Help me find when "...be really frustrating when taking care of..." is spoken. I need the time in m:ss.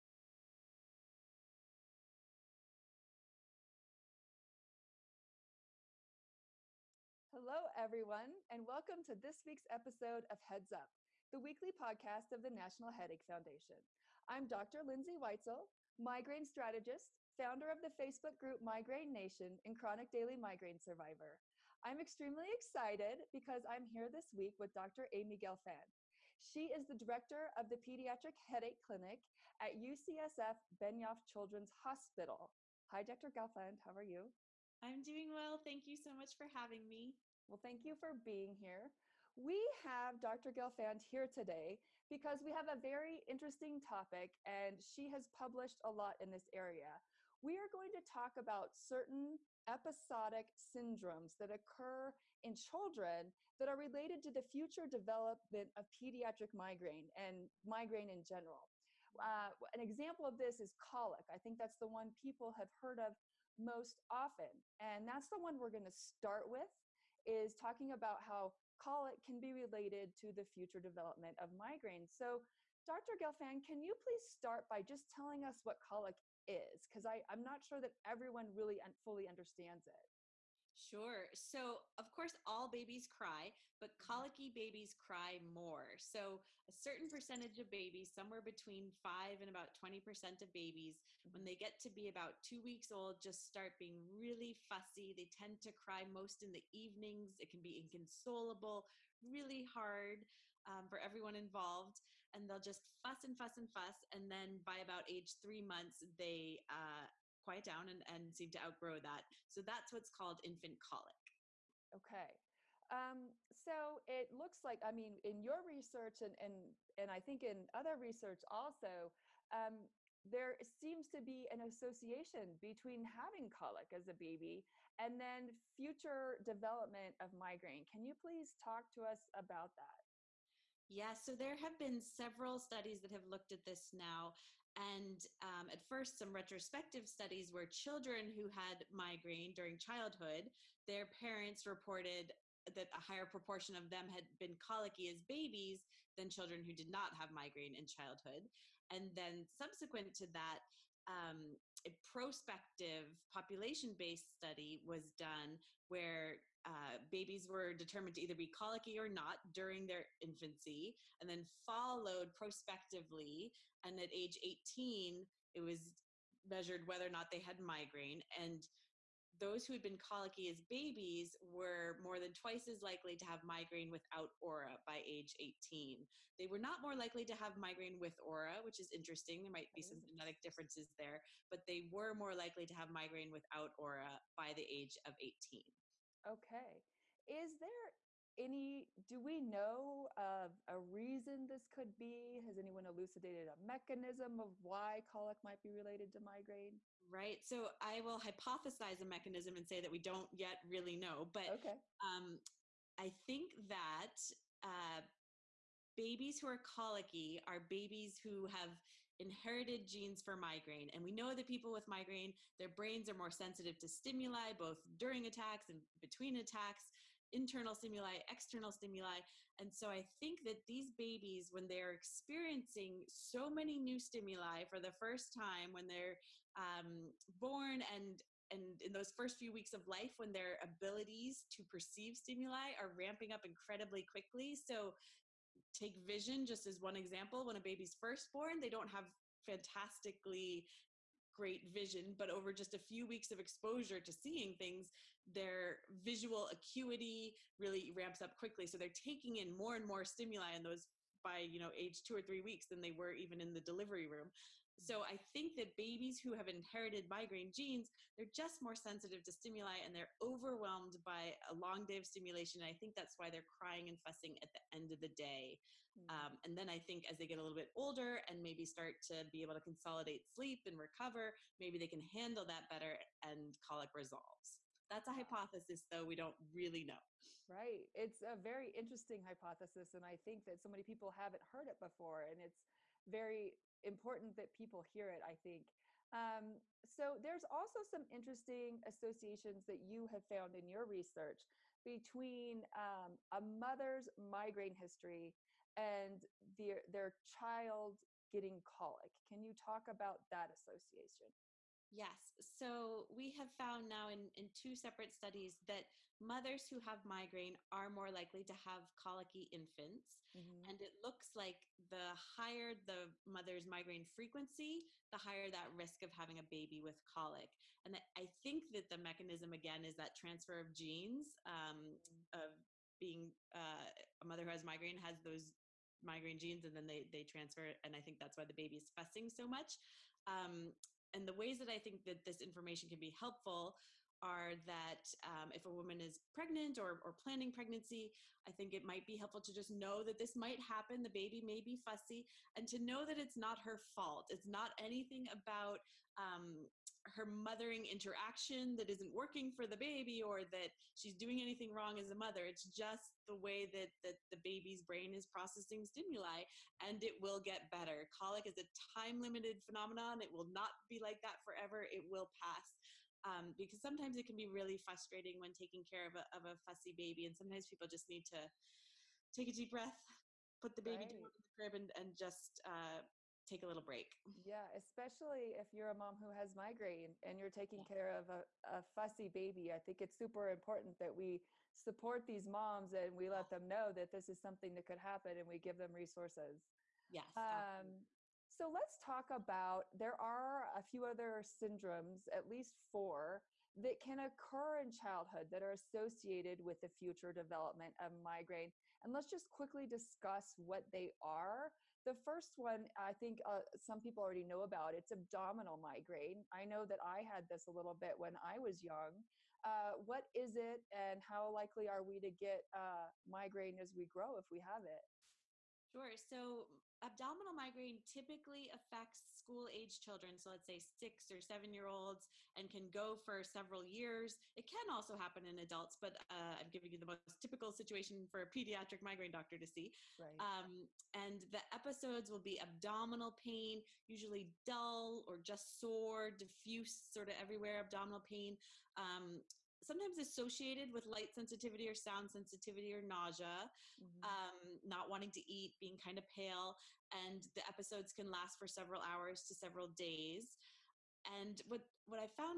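6:04.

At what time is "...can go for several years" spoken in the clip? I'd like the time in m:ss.
7:02.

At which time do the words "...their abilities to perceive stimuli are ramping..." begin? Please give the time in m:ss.
3:50.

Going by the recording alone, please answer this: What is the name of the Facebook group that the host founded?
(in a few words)
Migraine Nation.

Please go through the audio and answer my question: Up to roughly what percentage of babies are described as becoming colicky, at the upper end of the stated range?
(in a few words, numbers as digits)
20%.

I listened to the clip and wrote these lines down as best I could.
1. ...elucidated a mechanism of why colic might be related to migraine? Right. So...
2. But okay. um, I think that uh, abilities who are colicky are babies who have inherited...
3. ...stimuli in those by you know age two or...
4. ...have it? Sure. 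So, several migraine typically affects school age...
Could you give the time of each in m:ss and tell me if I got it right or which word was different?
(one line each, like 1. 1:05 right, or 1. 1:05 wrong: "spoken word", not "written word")
1. 3:12 right
2. 3:21 wrong: "babies", not "abilities"
3. 4:10 right
4. 6:54 wrong: "abdominal", not "several".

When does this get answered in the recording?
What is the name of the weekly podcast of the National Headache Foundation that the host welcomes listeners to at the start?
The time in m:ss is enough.
0:10.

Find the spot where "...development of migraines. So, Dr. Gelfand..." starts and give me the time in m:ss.
1:10.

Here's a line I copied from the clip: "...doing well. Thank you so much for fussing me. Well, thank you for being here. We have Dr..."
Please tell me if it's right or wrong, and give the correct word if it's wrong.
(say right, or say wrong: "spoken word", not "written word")
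wrong: "having", not "fussing".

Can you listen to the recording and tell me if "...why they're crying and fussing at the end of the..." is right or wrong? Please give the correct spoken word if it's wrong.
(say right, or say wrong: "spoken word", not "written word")
right.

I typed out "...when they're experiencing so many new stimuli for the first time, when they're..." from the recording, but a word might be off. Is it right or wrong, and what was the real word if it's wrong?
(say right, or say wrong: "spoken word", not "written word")
right.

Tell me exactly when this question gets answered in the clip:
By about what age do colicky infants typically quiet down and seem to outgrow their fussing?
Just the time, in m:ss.
1:45.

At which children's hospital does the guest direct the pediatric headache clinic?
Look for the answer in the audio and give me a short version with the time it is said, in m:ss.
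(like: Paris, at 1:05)
UCSF Benioff Children's Hospital, at 0:29.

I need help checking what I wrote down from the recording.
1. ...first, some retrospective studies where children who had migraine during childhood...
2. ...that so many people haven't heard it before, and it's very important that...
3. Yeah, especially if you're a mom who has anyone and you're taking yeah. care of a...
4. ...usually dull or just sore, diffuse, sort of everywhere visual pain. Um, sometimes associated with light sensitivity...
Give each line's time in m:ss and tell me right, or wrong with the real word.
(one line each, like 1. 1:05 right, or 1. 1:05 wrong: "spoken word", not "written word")
1. 2:15 right
2. 4:40 right
3. 6:14 wrong: "migraine", not "anyone"
4. 7:14 wrong: "abdominal", not "visual".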